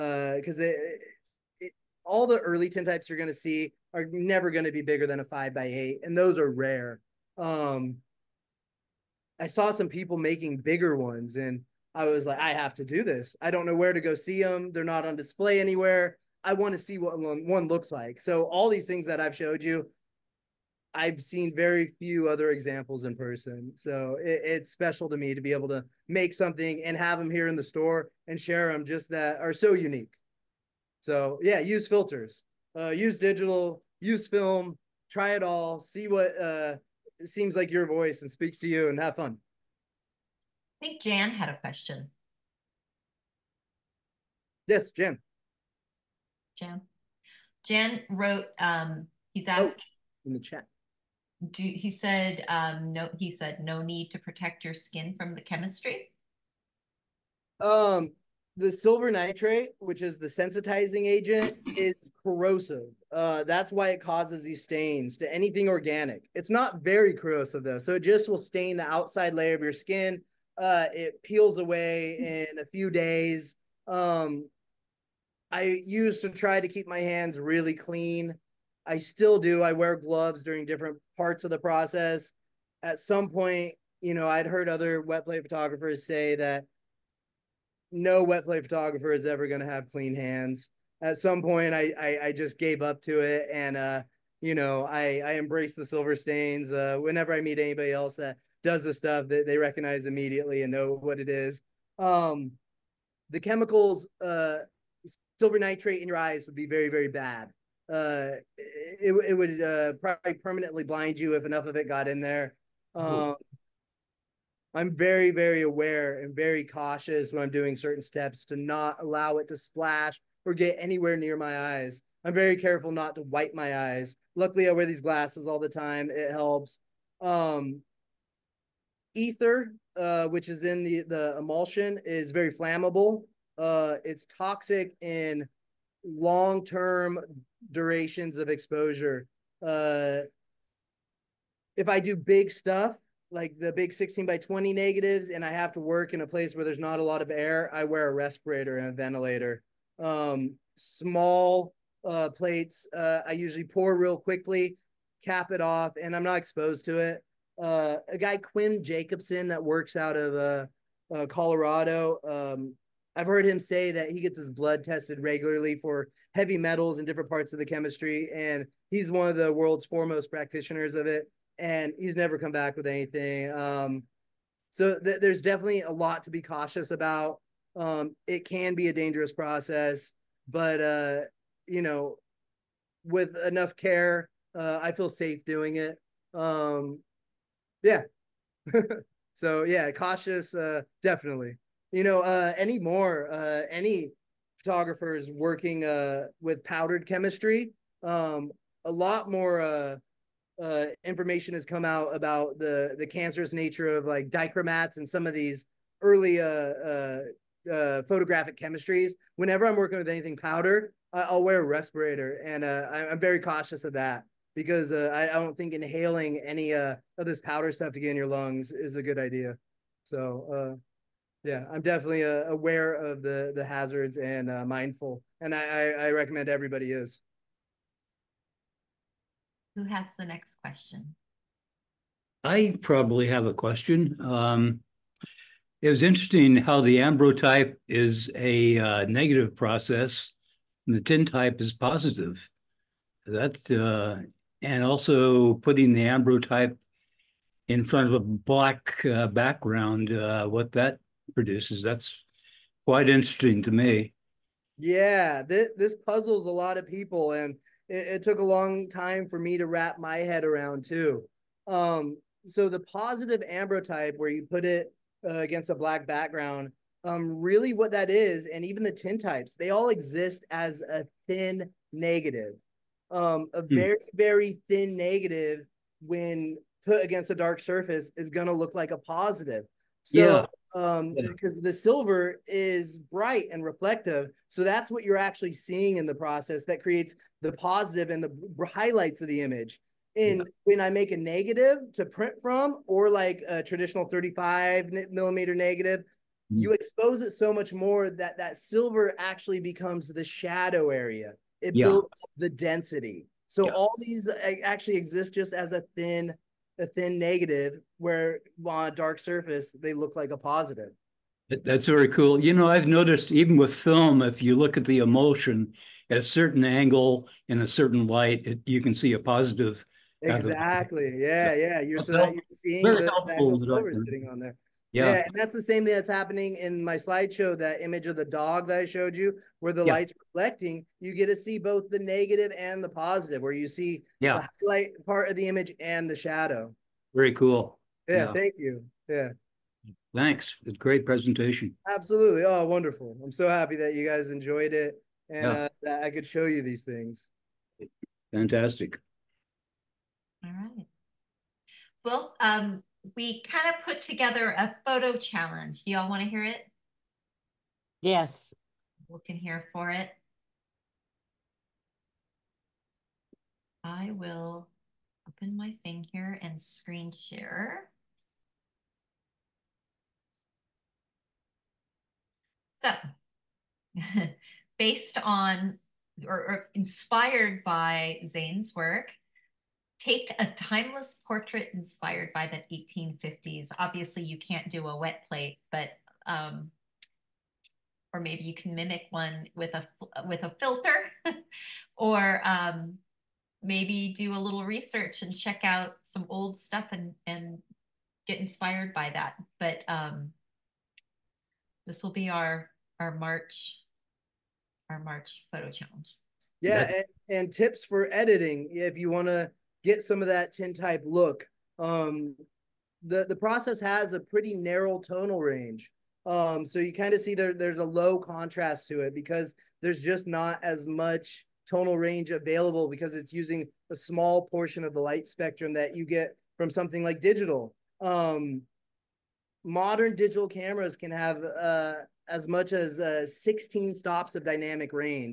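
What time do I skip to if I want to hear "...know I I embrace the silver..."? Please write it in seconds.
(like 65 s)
94 s.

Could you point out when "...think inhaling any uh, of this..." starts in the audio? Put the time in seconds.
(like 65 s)
215 s.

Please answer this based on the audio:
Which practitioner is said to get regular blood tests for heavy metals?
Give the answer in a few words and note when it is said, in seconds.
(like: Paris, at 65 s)
Quinn Jacobson, at 158 s.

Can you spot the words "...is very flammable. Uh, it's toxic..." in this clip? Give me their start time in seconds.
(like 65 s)
132 s.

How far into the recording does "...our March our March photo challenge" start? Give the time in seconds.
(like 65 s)
402 s.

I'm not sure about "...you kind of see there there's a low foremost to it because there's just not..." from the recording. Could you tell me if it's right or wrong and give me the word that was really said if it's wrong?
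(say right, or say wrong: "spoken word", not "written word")
wrong: "contrast", not "foremost".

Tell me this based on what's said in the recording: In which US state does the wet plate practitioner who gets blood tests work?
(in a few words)
Colorado.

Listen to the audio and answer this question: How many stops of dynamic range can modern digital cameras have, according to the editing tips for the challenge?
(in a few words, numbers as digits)
16.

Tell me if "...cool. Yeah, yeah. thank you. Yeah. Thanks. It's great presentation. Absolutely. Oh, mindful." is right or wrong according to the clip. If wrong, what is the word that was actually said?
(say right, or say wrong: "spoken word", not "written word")
wrong: "wonderful", not "mindful".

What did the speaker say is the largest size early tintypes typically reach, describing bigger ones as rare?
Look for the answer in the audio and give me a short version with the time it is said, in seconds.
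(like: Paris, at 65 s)
5 by 8, at 5 s.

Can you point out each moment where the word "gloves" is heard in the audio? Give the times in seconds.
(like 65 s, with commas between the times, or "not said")
79 s.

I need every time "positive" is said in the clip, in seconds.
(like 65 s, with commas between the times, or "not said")
241 s, 262 s, 278 s, 287 s, 310 s, 319 s, 332 s.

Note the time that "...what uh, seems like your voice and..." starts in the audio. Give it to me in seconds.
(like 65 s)
36 s.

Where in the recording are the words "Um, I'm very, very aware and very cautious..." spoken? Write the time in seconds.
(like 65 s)
112 s.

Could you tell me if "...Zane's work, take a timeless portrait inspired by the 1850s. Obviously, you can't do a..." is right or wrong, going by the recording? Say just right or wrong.
right.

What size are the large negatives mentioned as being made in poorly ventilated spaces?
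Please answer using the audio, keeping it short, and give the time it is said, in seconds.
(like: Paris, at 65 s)
16 by 20, at 143 s.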